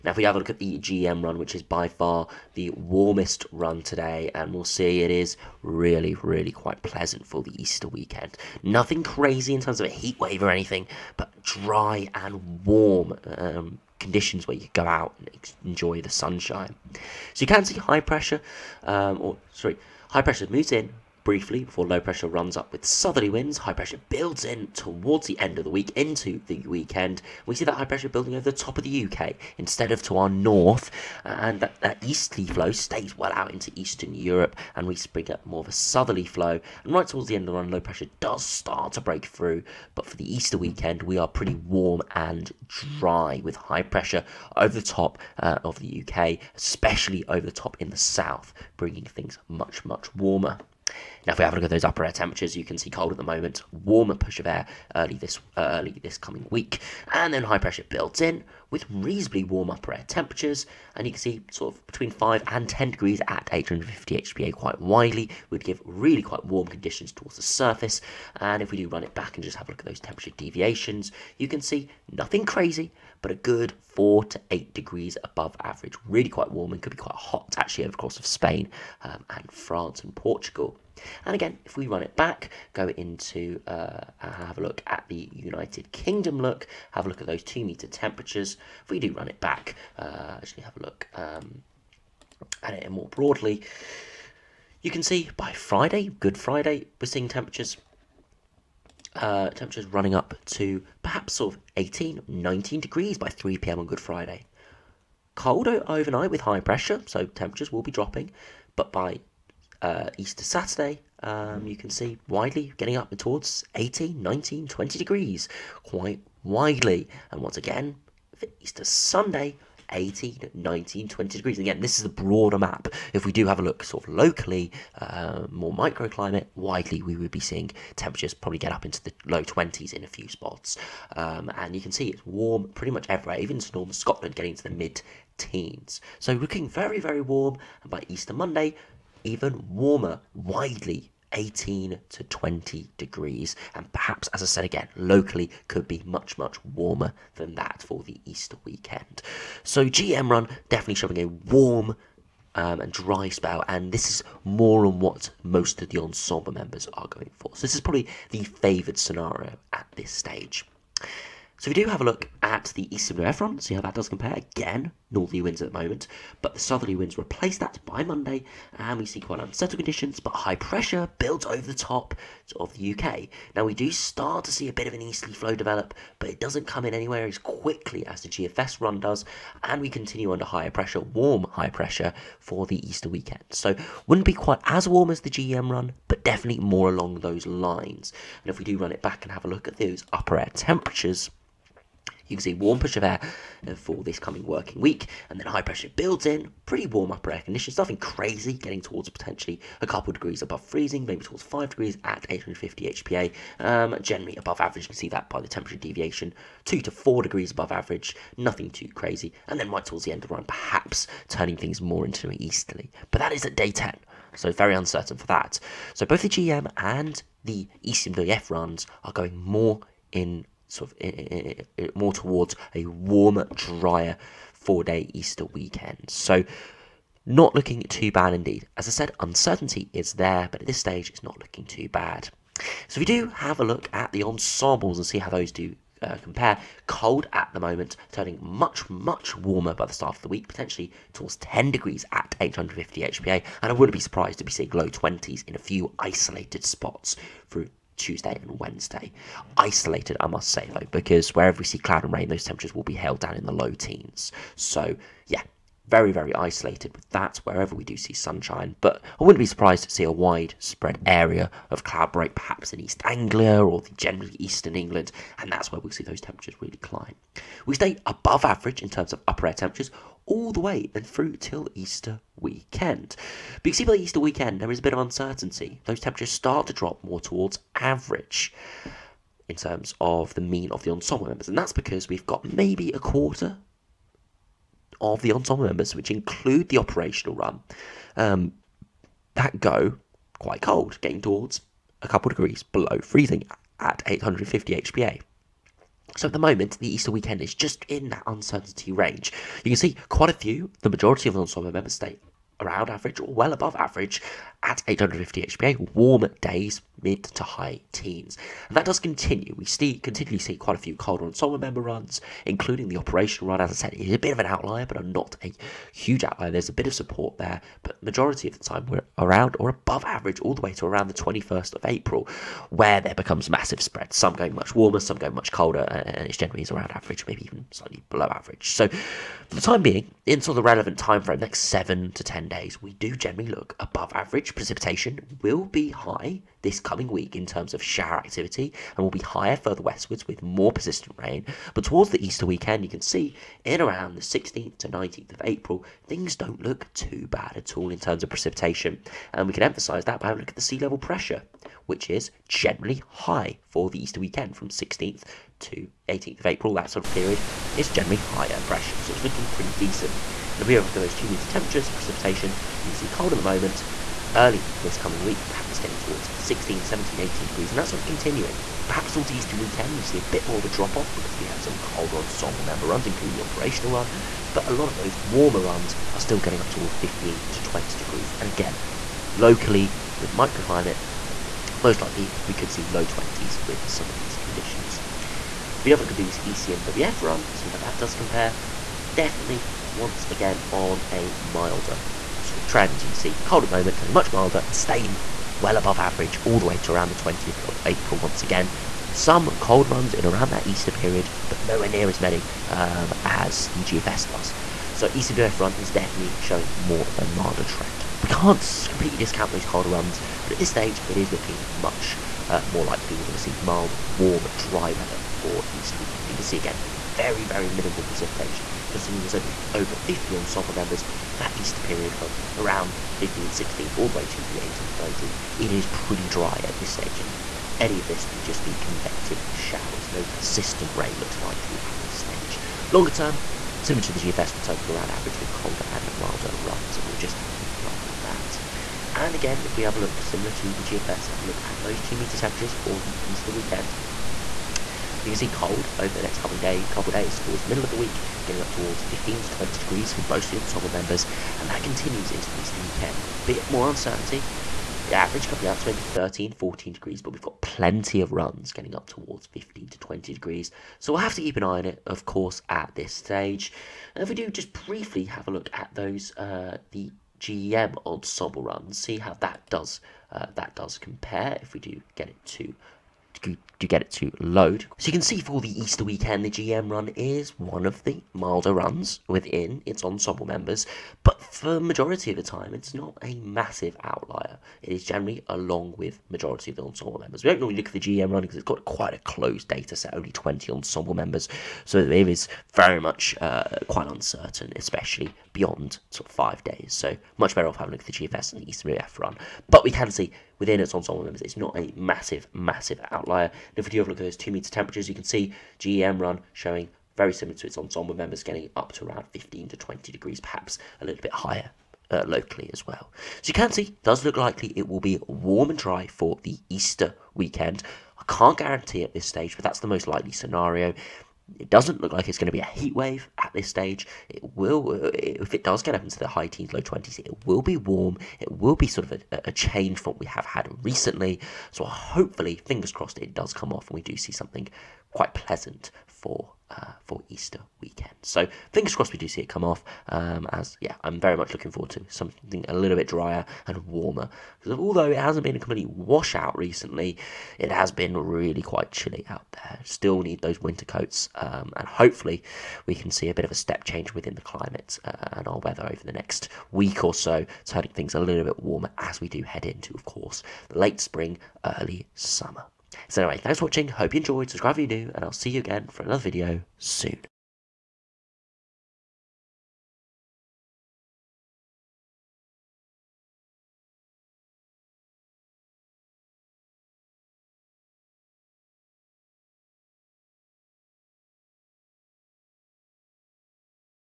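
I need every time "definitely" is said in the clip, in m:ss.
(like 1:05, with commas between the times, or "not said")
2:30, 3:06, 6:29, 6:45.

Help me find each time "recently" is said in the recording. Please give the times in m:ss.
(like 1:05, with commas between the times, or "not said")
8:50, 9:06.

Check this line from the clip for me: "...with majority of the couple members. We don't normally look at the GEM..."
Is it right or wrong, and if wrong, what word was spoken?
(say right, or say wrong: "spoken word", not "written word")
wrong: "ensemble", not "couple".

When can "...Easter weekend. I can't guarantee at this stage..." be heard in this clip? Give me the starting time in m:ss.
8:36.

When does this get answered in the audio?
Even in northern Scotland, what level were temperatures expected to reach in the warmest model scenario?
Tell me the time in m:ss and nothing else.
2:14.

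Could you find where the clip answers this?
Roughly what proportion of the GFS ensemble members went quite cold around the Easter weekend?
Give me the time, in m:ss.
4:42.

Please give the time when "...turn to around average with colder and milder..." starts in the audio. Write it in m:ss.
7:14.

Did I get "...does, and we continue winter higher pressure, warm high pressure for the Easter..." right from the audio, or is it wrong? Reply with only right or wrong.
wrong.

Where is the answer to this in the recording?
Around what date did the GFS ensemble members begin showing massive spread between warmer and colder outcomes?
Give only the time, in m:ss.
5:21.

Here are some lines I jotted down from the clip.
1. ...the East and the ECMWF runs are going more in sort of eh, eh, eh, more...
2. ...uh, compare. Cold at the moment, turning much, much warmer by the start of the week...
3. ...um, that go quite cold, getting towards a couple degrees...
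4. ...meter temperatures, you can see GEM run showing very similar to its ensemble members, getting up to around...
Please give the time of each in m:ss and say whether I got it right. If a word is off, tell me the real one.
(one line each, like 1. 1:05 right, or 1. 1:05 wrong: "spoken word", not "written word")
1. 3:36 wrong: "GEM", not "East"
2. 3:56 right
3. 4:48 right
4. 8:24 right.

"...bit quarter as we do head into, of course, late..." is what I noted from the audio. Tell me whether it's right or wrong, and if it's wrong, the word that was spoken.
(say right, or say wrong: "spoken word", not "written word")
wrong: "warmer", not "quarter".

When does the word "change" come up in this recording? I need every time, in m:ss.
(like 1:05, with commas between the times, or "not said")
8:49, 9:13.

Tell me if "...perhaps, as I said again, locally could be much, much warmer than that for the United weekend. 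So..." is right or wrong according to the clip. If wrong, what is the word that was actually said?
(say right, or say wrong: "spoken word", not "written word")
wrong: "Easter", not "United".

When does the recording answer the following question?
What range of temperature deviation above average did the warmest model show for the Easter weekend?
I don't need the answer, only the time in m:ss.
1:13.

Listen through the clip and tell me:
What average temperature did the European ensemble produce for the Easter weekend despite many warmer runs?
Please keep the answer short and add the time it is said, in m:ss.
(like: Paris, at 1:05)
13, 14 degrees, at 7:36.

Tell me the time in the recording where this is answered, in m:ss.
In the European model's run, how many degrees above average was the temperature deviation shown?
3:26.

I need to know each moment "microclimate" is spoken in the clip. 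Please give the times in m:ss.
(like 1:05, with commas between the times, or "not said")
2:05, 6:20.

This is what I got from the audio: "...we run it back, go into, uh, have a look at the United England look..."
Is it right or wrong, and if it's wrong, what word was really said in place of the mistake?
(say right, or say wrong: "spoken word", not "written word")
wrong: "Kingdom", not "England".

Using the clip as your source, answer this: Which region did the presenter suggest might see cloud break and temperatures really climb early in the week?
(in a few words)
East Anglia.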